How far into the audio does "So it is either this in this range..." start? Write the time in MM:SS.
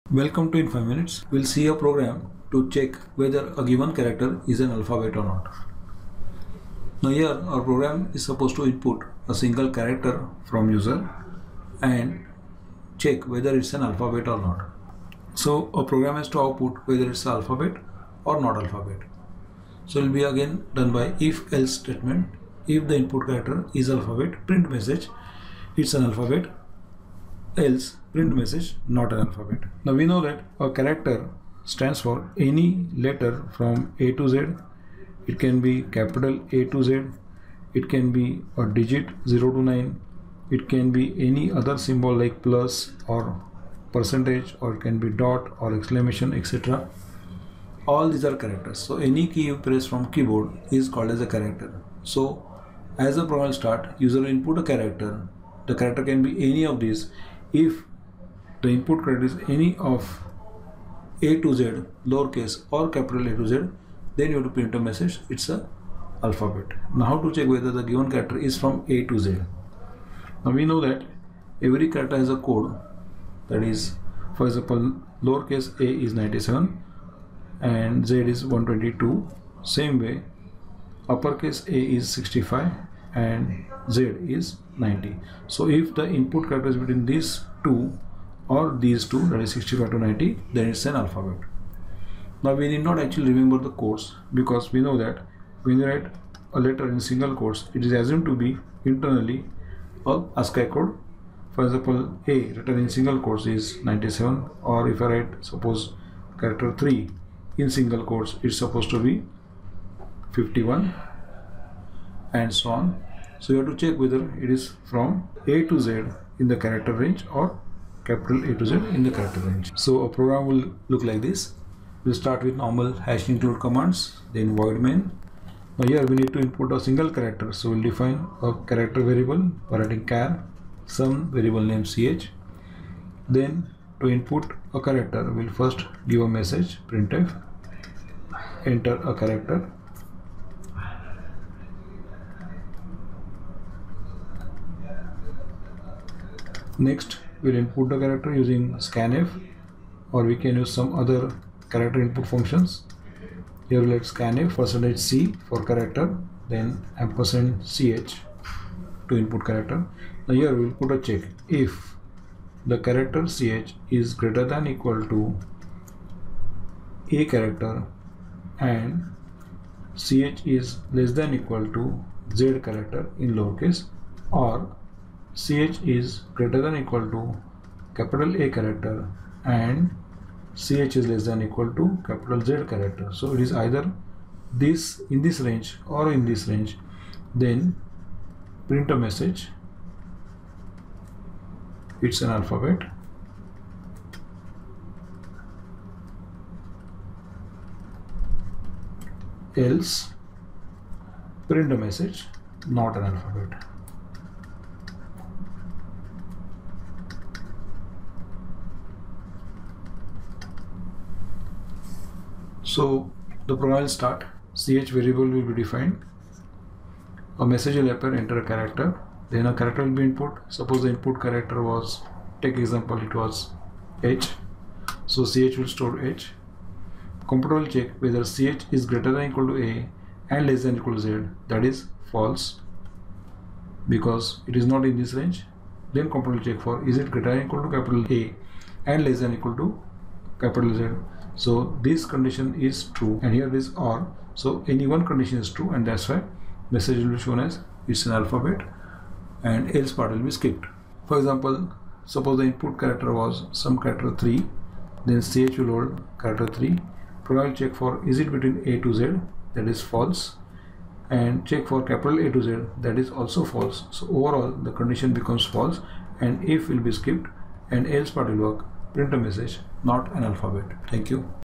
03:03.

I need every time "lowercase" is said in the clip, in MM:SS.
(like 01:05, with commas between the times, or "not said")
01:02, 01:15, 02:53.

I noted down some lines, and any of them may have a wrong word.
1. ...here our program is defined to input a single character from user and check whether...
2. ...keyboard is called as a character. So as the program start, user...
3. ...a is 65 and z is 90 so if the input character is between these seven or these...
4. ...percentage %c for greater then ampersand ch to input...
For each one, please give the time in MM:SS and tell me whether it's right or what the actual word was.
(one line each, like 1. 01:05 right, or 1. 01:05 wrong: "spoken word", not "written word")
1. 00:07 wrong: "supposed", not "defined"
2. 00:50 right
3. 01:21 wrong: "two", not "seven"
4. 02:34 wrong: "character", not "greater".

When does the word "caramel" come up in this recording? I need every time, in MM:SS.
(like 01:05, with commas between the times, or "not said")
not said.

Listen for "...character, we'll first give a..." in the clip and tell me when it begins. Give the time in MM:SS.
02:14.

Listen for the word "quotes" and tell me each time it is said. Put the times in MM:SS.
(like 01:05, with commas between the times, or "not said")
01:37, 01:43, 01:48.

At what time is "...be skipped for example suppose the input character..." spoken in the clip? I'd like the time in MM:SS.
04:10.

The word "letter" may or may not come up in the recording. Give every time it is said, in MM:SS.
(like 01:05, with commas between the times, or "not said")
00:32, 01:36.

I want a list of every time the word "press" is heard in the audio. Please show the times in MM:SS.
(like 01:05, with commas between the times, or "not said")
00:49.